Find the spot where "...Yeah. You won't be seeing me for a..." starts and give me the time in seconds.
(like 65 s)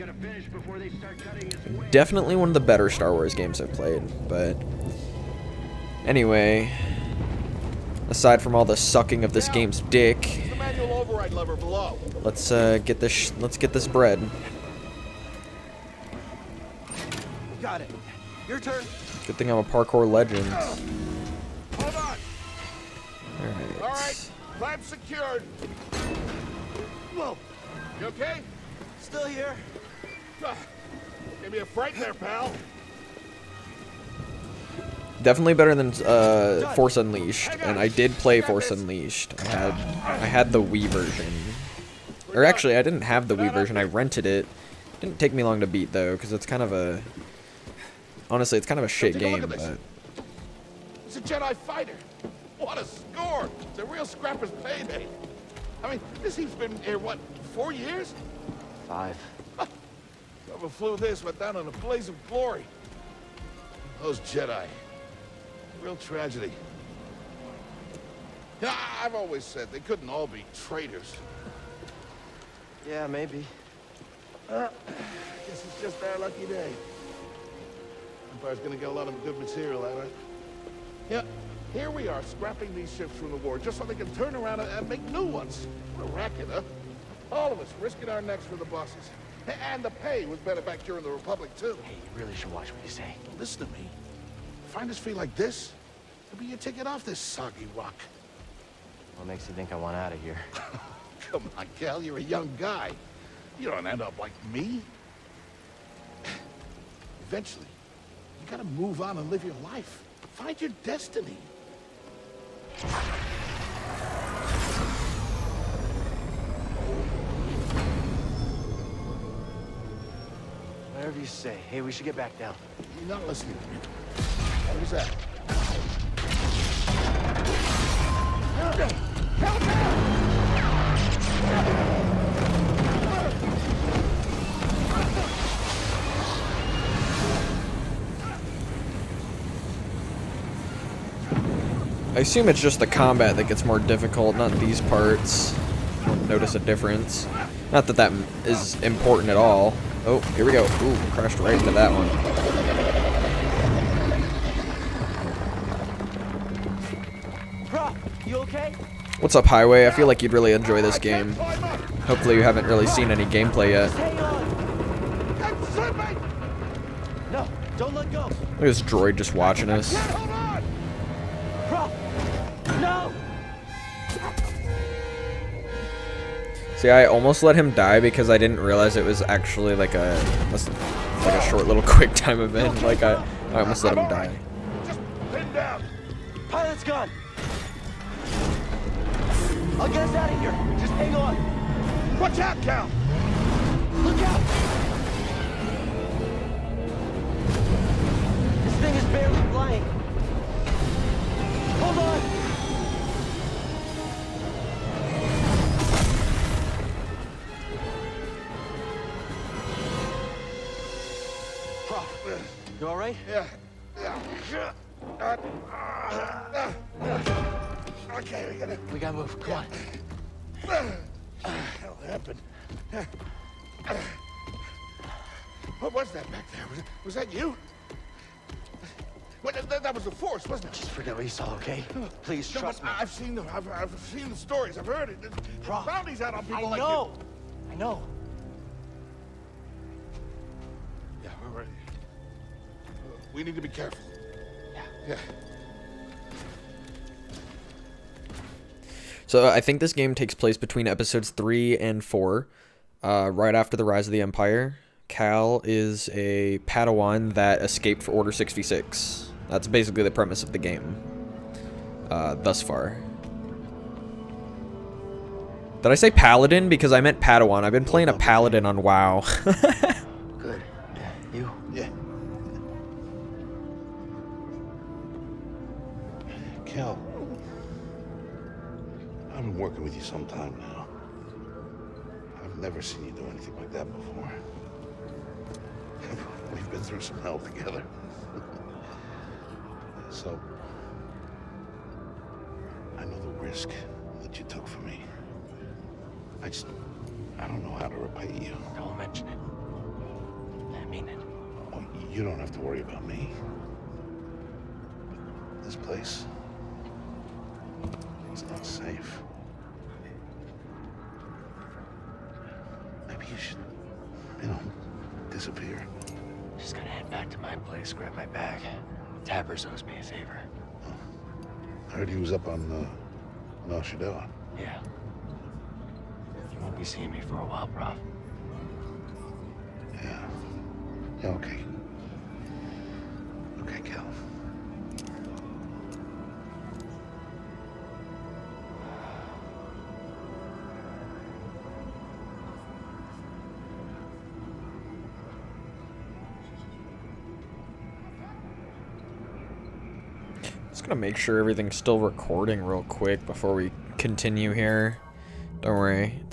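324 s.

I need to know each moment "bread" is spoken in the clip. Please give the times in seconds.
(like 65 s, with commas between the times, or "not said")
13 s.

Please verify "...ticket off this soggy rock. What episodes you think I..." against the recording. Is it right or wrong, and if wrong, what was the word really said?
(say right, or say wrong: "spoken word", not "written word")
wrong: "makes", not "episodes".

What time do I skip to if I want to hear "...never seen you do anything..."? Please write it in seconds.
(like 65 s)
282 s.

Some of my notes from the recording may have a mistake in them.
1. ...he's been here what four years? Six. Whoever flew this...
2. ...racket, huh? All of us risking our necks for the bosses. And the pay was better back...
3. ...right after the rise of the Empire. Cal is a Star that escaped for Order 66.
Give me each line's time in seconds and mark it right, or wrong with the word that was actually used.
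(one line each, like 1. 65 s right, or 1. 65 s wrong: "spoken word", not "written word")
1. 56 s wrong: "Five", not "Six"
2. 86 s right
3. 253 s wrong: "Padawan", not "Star".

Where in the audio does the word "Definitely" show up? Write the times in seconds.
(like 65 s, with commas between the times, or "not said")
1 s, 35 s.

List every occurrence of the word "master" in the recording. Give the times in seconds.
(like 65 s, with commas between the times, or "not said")
not said.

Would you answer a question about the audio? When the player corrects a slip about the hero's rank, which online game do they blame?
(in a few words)
WoW.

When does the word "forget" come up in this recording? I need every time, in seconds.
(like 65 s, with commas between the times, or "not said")
230 s.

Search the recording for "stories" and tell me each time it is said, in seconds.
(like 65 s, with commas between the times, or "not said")
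234 s.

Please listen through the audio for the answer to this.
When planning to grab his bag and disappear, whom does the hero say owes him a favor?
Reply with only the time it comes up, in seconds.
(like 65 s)
319 s.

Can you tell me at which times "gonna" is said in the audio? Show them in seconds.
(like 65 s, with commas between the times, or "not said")
78 s, 350 s.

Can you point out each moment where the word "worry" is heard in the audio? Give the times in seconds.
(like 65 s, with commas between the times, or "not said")
302 s, 355 s.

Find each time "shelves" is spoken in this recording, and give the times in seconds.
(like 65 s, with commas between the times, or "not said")
not said.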